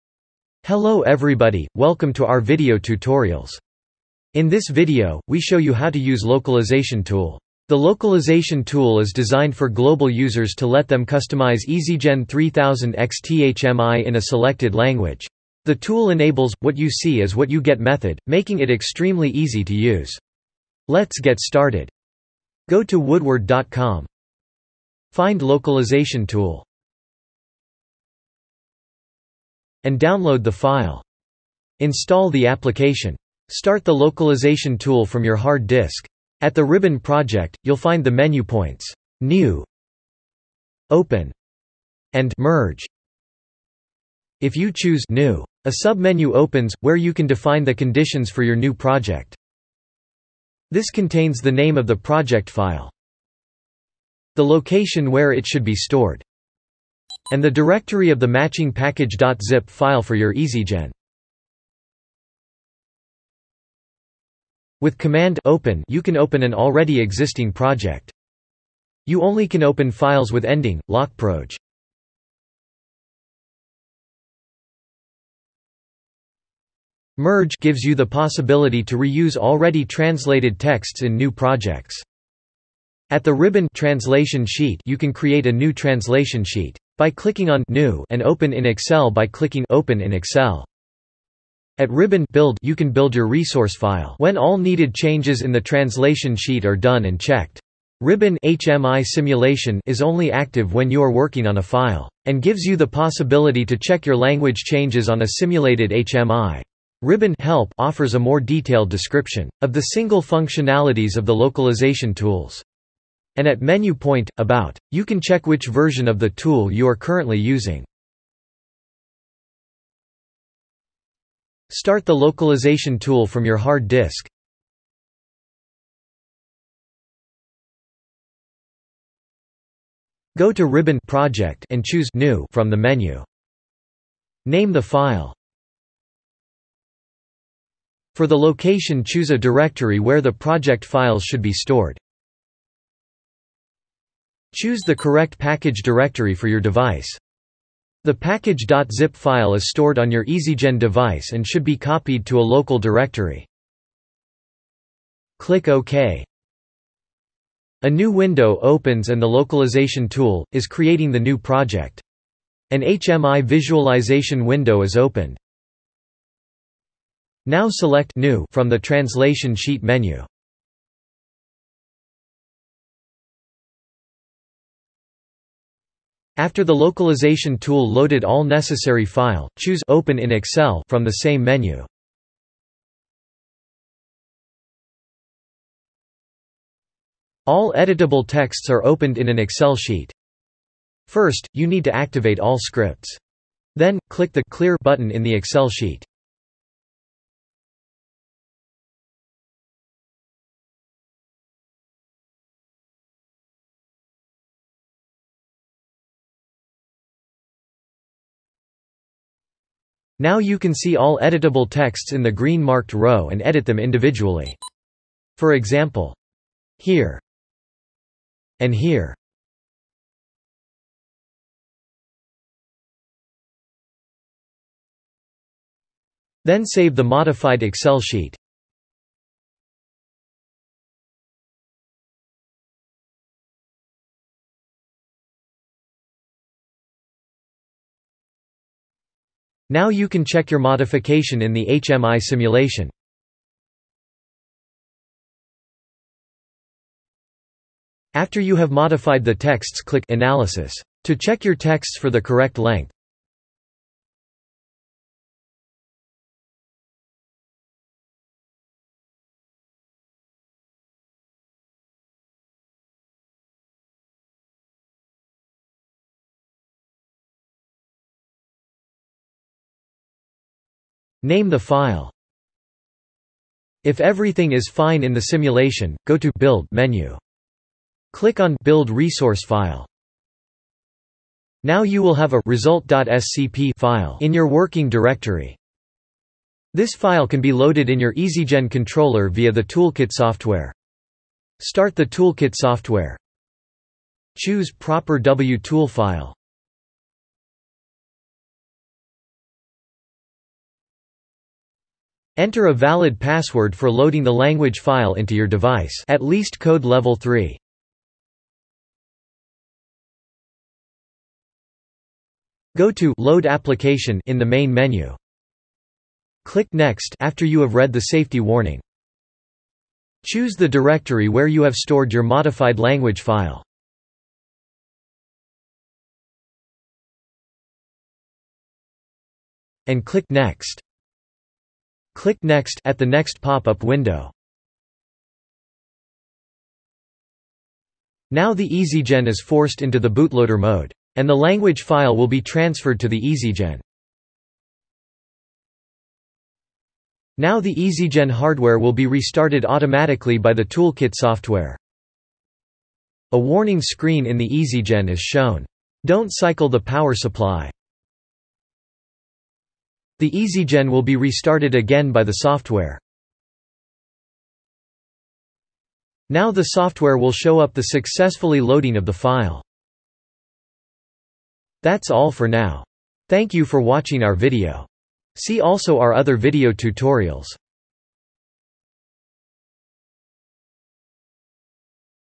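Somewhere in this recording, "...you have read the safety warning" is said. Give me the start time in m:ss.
5:17.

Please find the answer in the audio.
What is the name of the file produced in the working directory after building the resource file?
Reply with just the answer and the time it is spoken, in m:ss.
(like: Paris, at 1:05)
result.scp, at 4:42.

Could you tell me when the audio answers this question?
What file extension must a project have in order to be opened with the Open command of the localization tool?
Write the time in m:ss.
1:10.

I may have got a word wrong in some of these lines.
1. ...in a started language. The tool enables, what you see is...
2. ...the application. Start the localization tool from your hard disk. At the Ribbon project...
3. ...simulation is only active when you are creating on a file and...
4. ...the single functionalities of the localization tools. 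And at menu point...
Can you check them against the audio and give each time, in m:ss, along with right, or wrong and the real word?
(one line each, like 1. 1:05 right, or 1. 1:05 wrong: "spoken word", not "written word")
1. 0:14 wrong: "selected", not "started"
2. 0:32 right
3. 1:39 wrong: "working", not "creating"
4. 1:49 right.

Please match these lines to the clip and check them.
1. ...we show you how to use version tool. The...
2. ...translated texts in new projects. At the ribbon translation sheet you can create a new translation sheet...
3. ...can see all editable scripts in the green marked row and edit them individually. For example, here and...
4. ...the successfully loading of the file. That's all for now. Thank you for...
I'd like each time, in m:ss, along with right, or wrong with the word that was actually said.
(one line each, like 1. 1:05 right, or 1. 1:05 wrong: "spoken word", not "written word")
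1. 0:05 wrong: "localization", not "version"
2. 1:19 right
3. 3:30 wrong: "texts", not "scripts"
4. 6:07 right.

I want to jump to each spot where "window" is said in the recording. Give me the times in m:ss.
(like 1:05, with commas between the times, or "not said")
2:38, 2:44, 5:33.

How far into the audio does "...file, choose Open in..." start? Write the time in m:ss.
2:59.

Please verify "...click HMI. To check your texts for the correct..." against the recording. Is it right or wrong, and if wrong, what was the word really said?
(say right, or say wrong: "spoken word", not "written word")
wrong: "Analysis", not "HMI".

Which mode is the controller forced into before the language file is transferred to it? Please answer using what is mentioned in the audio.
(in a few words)
bootloader mode.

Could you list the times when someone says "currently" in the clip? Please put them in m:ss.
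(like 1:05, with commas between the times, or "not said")
1:56.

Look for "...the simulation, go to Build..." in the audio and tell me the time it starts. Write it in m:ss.
4:35.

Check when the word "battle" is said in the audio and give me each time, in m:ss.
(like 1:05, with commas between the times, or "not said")
not said.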